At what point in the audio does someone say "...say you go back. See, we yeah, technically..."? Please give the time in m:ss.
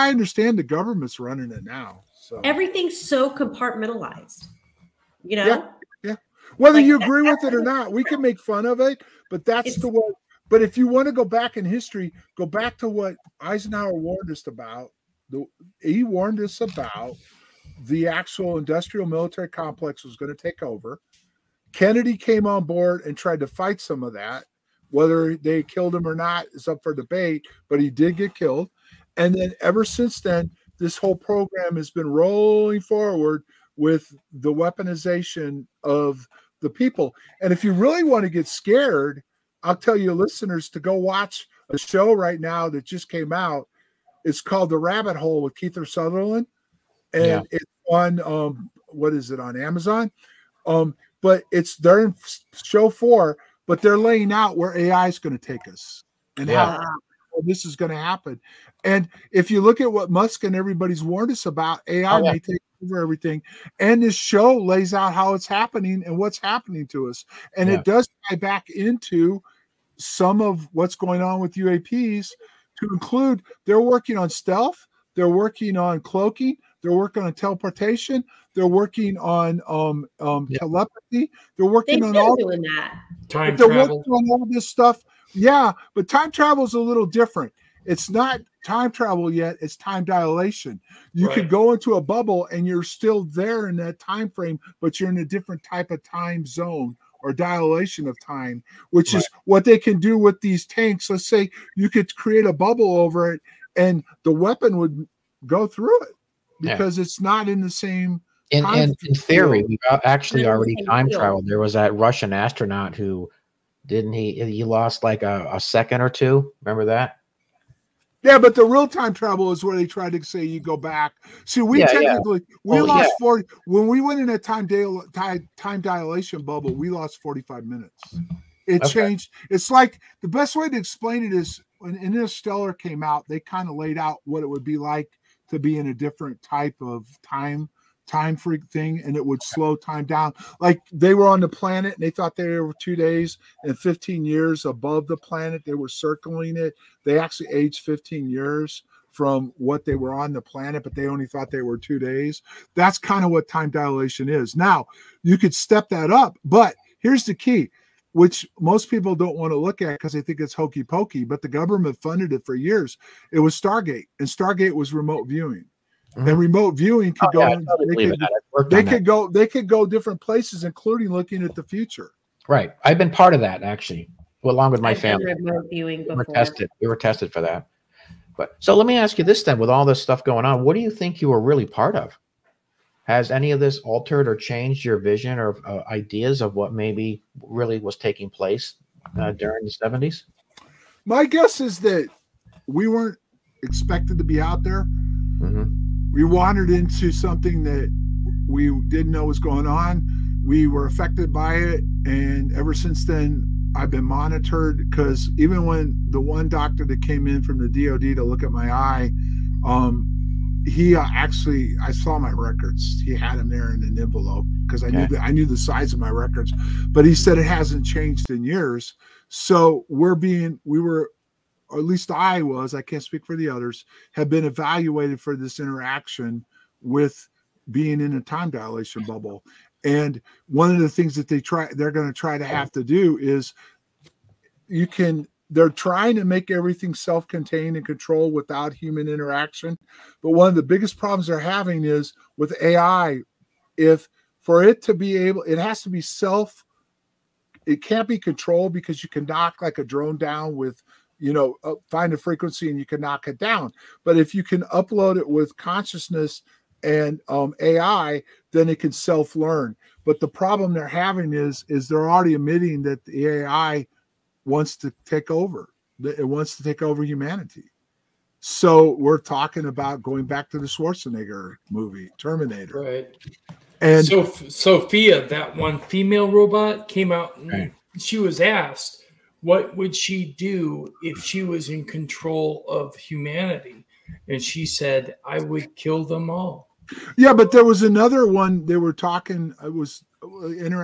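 2:00.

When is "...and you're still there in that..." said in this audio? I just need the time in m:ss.
1:32.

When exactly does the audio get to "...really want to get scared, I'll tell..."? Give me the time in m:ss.
0:37.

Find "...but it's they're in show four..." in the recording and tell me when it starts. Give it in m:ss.
0:51.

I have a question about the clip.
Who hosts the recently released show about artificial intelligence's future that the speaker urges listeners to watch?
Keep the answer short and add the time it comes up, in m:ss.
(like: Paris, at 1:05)
Kiefer Sutherland, at 0:45.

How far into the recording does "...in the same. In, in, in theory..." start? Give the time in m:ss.
1:47.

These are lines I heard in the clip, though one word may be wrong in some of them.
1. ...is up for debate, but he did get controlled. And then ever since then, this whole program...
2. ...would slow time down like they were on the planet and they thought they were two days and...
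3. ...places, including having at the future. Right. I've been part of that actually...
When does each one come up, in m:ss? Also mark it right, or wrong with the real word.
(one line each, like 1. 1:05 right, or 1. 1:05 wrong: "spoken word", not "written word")
1. 0:26 wrong: "killed", not "controlled"
2. 2:19 right
3. 2:50 wrong: "looking", not "having".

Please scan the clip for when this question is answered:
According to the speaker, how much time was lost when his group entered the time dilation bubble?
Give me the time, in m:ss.
2:07.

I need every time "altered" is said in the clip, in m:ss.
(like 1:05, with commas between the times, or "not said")
3:03.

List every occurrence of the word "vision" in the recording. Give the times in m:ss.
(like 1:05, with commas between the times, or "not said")
3:04.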